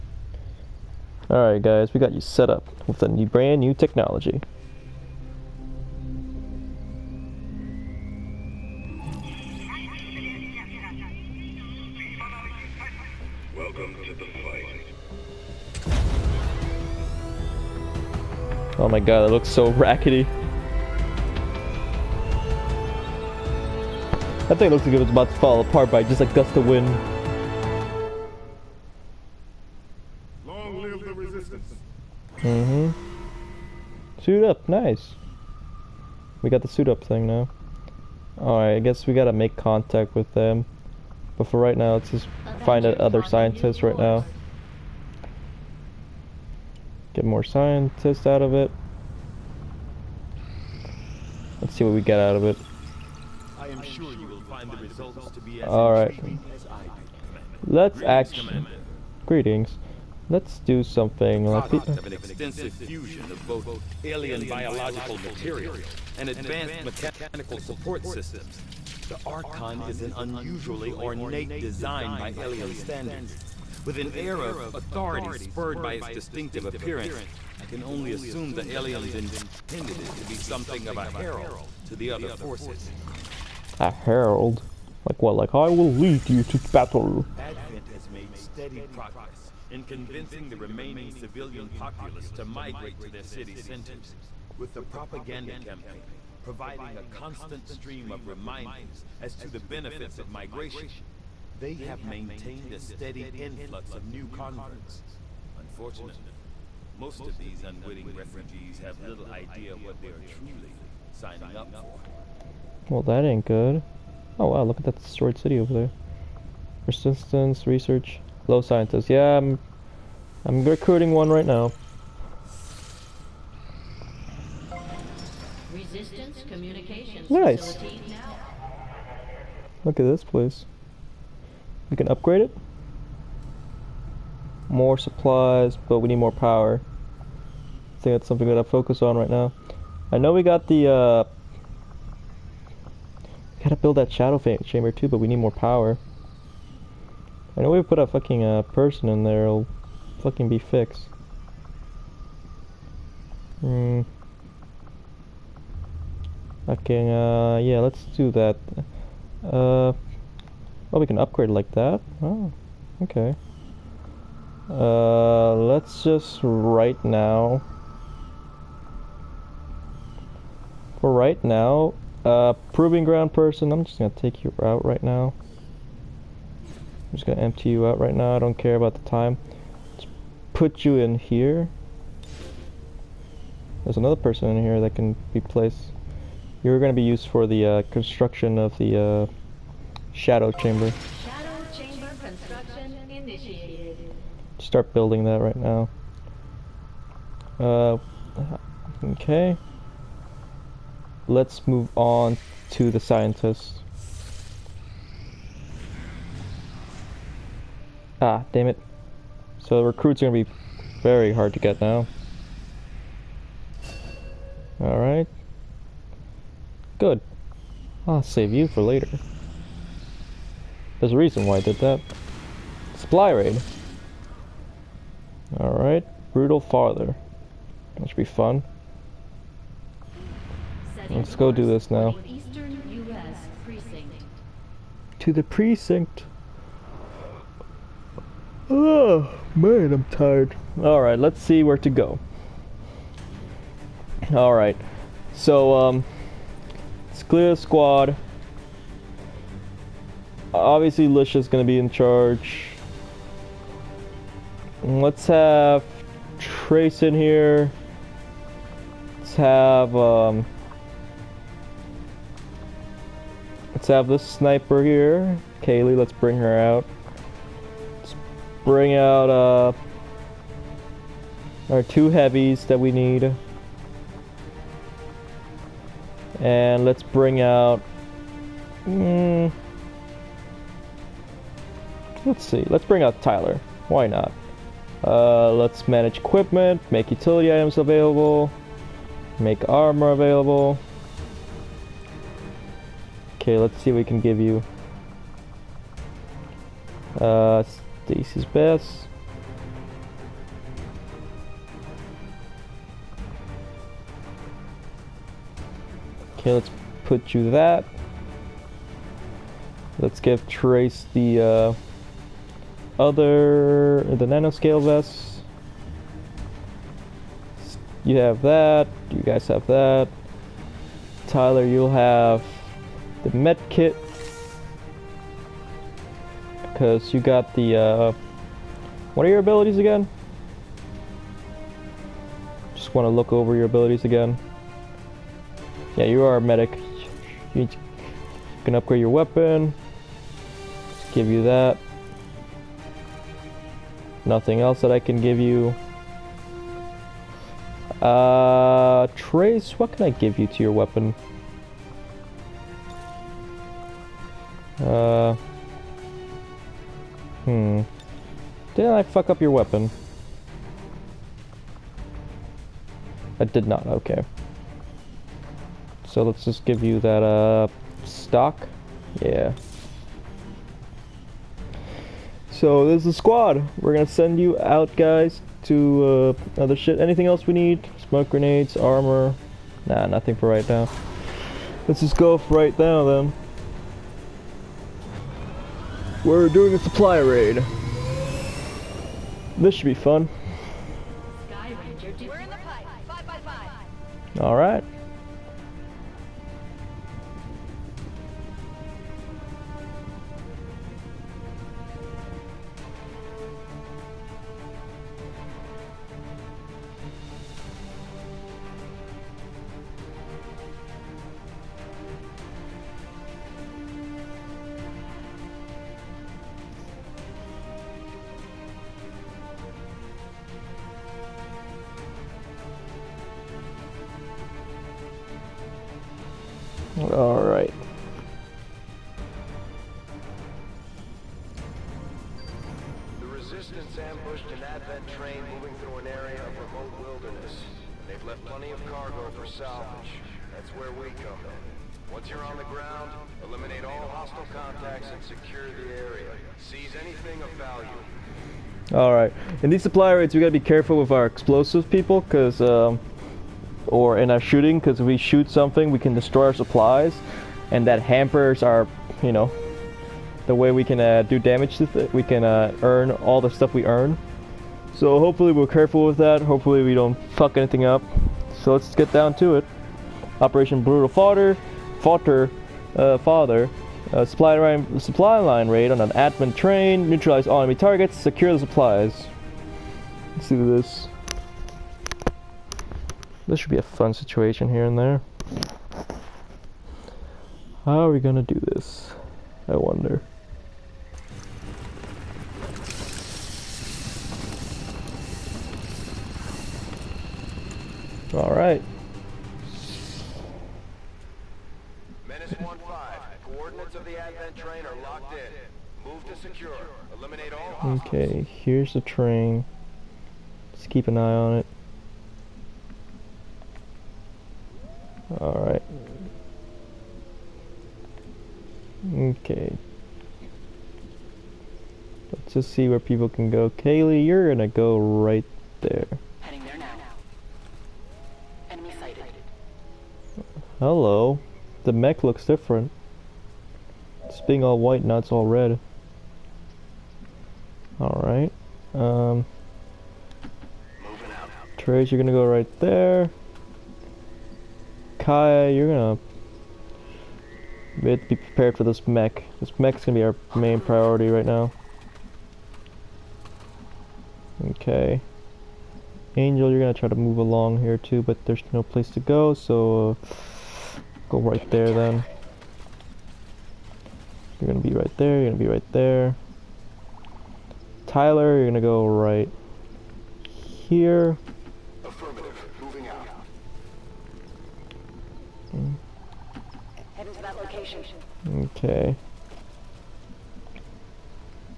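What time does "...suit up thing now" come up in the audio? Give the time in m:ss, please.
0:36.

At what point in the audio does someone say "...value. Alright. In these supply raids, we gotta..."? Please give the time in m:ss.
7:27.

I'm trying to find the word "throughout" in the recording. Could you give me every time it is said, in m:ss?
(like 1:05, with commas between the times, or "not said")
not said.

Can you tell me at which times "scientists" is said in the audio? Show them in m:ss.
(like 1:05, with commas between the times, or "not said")
0:43, 0:47, 1:58, 3:22.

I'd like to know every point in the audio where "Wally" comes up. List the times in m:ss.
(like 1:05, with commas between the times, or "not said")
not said.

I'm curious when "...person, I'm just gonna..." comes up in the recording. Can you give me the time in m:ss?
2:53.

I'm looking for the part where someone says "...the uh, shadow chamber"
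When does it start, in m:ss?
3:08.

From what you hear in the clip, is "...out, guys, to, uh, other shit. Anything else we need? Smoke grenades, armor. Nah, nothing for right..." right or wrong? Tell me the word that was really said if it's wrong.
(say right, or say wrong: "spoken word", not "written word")
right.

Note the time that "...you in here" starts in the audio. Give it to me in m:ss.
3:00.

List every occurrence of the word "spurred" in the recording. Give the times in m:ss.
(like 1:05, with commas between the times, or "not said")
1:15.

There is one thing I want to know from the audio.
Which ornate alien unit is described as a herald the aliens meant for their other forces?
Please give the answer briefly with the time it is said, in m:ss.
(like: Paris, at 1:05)
The Archon, at 1:09.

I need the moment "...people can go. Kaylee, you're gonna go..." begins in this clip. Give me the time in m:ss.
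8:42.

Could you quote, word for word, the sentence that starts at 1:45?
Unfortunately, most of these unwitting refugees have little idea what they are truly signing up for.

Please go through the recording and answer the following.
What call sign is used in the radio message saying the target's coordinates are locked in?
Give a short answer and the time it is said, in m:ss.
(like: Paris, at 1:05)
Menace 1-5, at 8:22.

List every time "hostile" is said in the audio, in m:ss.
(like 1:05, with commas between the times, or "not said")
7:24.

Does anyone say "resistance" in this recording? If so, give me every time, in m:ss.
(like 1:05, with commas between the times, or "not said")
0:31, 2:05.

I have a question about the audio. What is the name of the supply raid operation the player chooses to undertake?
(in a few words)
Brutal Father.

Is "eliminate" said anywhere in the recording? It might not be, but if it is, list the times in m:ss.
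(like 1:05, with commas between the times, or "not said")
7:23, 8:27.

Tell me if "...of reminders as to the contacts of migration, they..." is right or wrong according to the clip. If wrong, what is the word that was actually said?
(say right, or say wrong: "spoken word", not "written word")
wrong: "benefits", not "contacts".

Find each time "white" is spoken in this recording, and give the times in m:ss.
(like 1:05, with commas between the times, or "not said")
8:54.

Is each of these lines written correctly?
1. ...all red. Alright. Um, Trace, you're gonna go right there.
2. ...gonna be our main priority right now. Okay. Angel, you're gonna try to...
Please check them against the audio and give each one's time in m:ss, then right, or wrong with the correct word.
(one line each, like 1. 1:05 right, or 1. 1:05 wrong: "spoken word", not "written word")
1. 8:55 right
2. 9:10 right.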